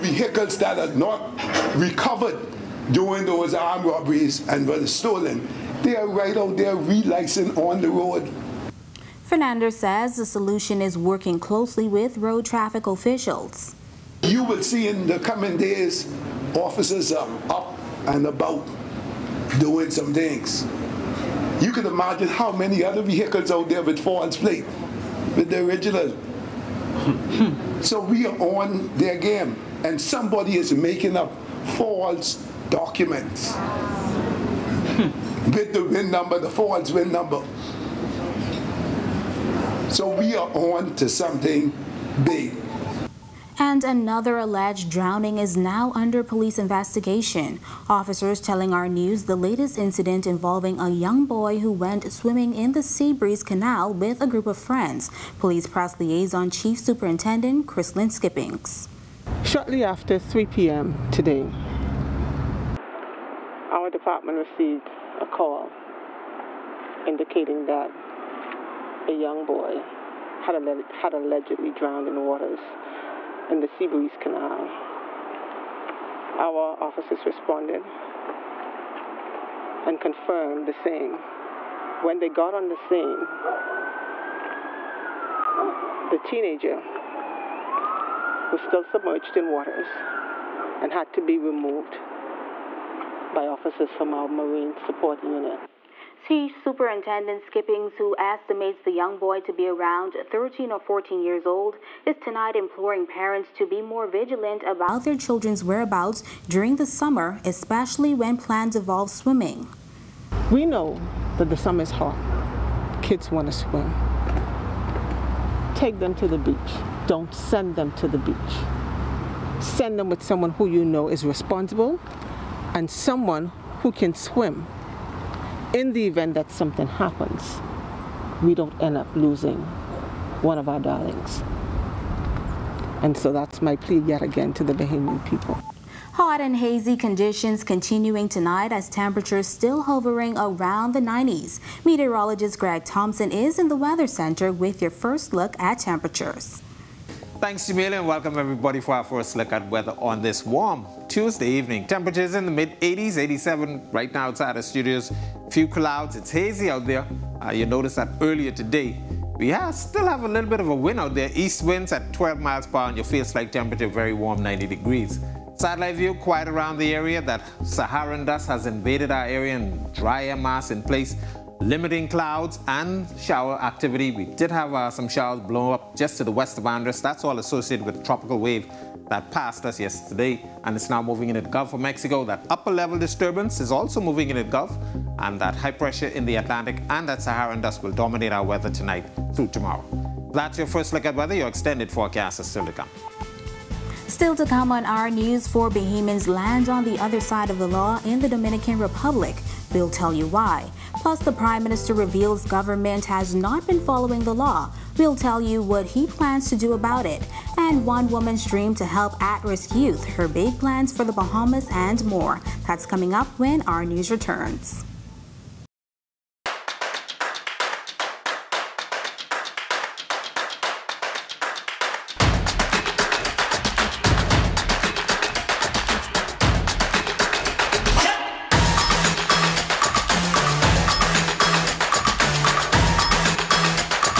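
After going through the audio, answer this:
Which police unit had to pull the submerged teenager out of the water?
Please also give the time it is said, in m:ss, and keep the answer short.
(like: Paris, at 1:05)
Marine Support Unit, at 1:34.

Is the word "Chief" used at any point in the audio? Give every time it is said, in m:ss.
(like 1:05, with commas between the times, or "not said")
0:56, 1:36.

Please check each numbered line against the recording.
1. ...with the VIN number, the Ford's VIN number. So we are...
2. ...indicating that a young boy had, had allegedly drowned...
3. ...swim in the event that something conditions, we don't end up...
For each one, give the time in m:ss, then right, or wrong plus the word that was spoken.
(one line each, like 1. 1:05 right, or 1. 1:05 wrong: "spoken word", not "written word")
1. 0:35 right
2. 1:07 right
3. 2:04 wrong: "happens", not "conditions".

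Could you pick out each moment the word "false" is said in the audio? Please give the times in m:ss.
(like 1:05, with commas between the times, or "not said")
0:23, 0:31.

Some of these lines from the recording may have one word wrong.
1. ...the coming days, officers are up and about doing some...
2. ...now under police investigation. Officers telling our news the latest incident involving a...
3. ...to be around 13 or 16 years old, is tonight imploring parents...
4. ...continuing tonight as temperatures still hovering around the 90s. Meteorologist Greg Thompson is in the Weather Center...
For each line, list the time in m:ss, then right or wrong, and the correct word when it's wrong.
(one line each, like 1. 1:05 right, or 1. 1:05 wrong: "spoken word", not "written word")
1. 0:15 right
2. 0:45 right
3. 1:39 wrong: "14", not "16"
4. 2:17 right.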